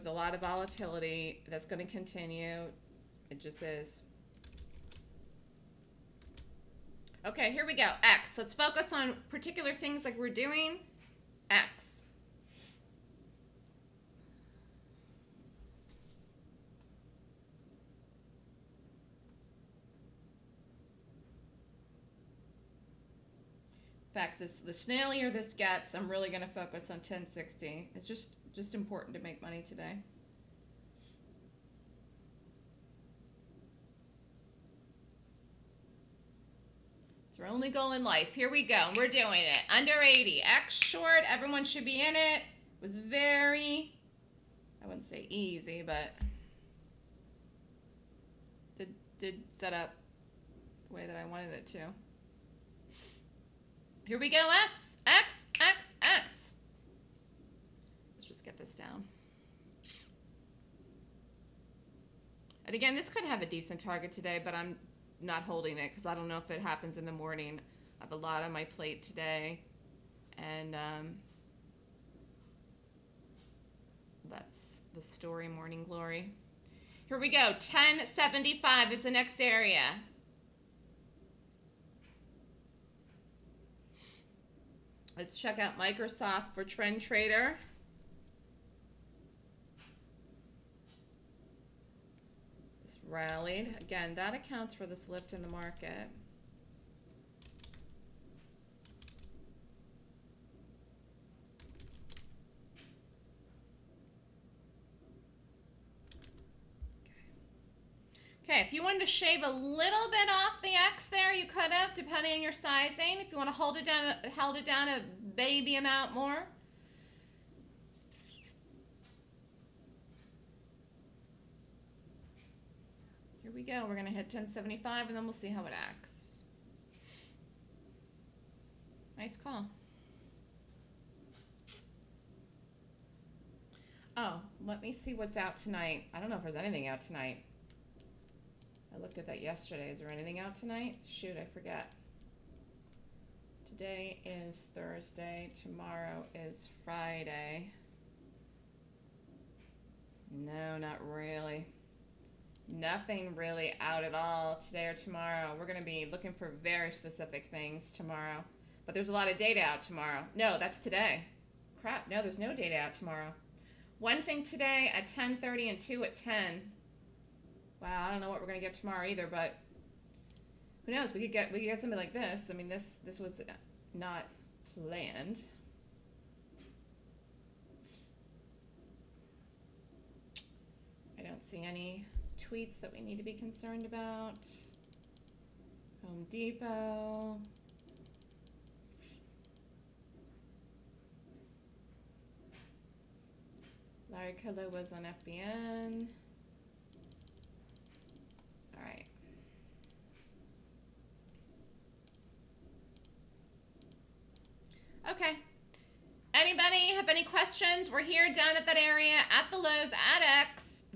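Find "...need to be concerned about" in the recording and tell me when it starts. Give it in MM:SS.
03:03.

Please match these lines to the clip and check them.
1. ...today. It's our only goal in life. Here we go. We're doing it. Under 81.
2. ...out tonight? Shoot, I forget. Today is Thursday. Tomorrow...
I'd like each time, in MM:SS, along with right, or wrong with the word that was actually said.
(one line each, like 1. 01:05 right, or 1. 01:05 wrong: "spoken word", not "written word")
1. 00:29 wrong: "80", not "81"
2. 02:20 right.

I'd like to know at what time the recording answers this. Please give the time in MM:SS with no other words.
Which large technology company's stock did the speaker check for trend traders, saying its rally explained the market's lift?
01:25.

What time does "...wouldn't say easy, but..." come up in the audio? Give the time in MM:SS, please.
00:44.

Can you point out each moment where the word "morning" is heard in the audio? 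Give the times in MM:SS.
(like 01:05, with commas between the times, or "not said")
01:07, 01:15.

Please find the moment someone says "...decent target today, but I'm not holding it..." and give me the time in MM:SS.
01:03.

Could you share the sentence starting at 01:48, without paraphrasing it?
Okay, if you wanted to shave a little bit off the X there, you could have, depending on your sizing.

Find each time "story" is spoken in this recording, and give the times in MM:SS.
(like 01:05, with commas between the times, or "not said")
01:15.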